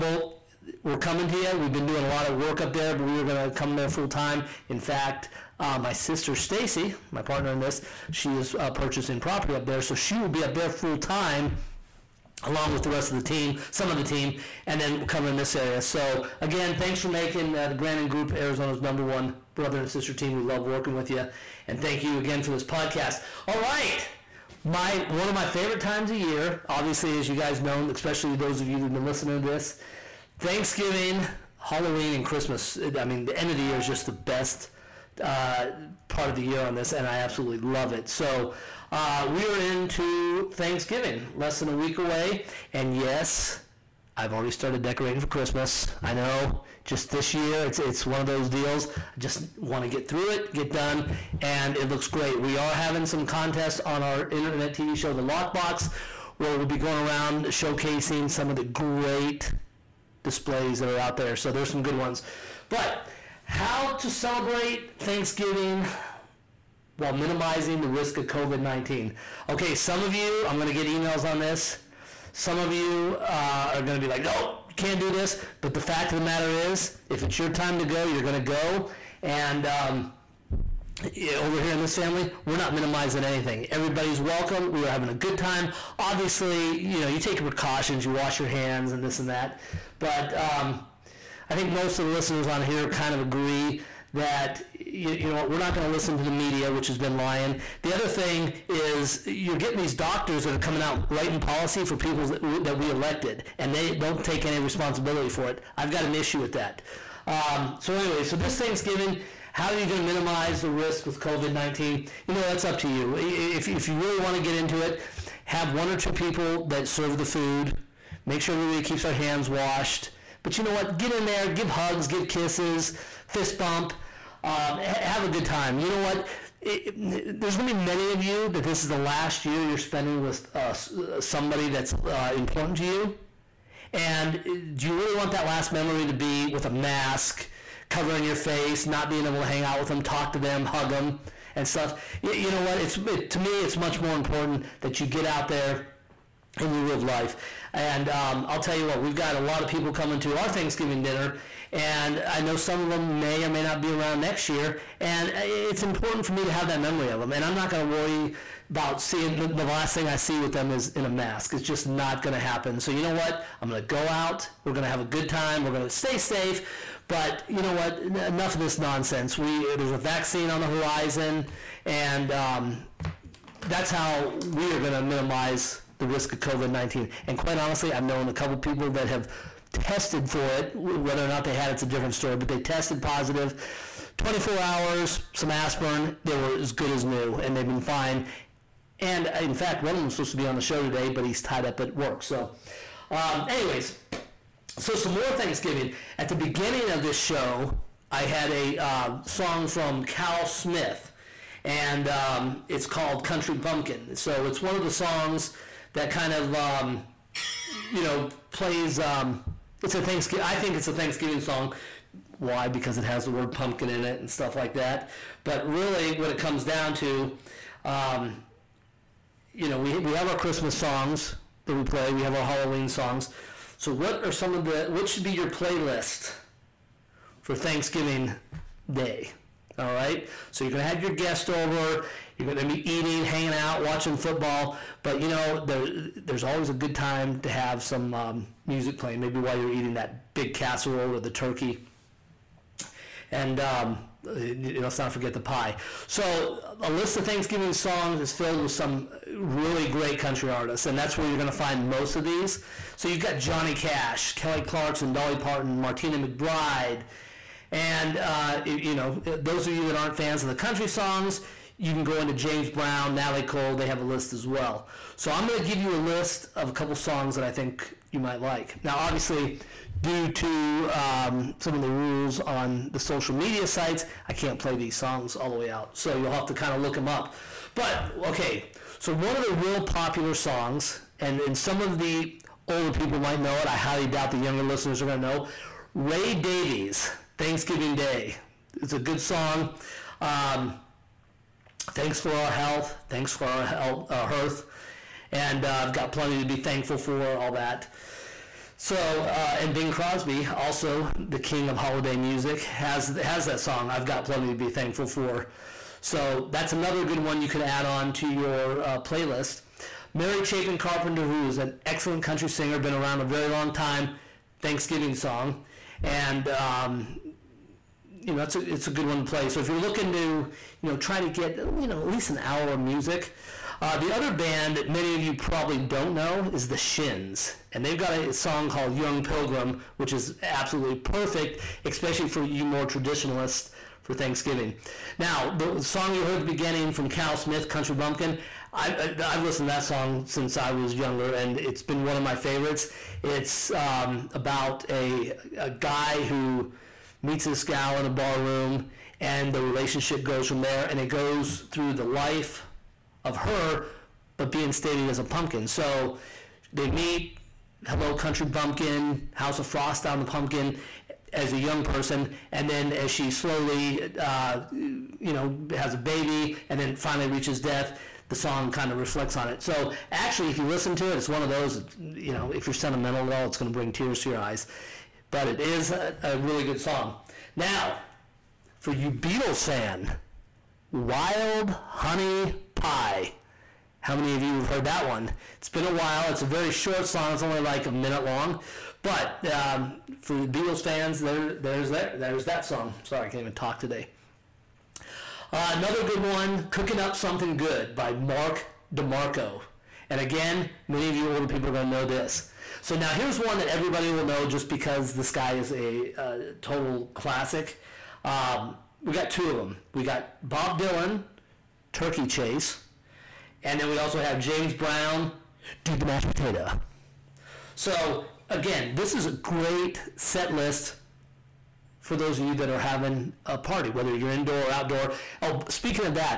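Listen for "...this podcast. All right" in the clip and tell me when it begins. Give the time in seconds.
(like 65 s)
22 s.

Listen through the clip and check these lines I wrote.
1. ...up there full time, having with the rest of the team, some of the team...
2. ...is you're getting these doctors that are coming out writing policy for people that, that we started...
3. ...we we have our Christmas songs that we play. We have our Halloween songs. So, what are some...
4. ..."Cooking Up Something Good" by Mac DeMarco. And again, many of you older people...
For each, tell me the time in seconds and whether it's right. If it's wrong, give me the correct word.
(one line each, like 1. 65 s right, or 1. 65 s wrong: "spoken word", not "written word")
1. 10 s wrong: "along", not "having"
2. 98 s wrong: "elected", not "started"
3. 219 s right
4. 396 s right.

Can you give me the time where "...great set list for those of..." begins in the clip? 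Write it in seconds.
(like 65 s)
419 s.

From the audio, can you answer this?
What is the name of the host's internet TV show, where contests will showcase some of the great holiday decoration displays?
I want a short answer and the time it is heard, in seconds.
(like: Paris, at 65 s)
The Lockbox, at 55 s.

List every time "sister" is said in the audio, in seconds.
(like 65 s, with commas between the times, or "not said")
5 s, 19 s.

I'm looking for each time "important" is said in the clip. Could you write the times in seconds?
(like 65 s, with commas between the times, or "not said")
132 s, 144 s, 155 s.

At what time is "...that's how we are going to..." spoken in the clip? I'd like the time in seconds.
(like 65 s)
173 s.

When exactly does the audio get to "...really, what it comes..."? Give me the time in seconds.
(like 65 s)
215 s.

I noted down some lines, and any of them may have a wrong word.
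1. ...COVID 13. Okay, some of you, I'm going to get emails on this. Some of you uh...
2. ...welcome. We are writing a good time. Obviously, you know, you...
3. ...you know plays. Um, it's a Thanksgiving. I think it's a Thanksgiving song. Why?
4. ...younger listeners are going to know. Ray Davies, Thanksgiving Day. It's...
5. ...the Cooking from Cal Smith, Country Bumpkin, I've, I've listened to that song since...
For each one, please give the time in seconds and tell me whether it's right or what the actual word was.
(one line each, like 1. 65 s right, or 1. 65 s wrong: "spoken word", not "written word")
1. 68 s wrong: "19", not "13"
2. 84 s wrong: "having", not "writing"
3. 207 s right
4. 284 s right
5. 336 s wrong: "beginning", not "Cooking".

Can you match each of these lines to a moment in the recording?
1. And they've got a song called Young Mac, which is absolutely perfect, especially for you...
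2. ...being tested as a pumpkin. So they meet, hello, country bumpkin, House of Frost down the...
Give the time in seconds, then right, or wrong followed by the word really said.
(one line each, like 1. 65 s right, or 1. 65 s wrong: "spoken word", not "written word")
1. 327 s wrong: "Pilgrim", not "Mac"
2. 354 s wrong: "stated", not "tested".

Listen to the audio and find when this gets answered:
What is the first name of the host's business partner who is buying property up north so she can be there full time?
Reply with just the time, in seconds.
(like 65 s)
6 s.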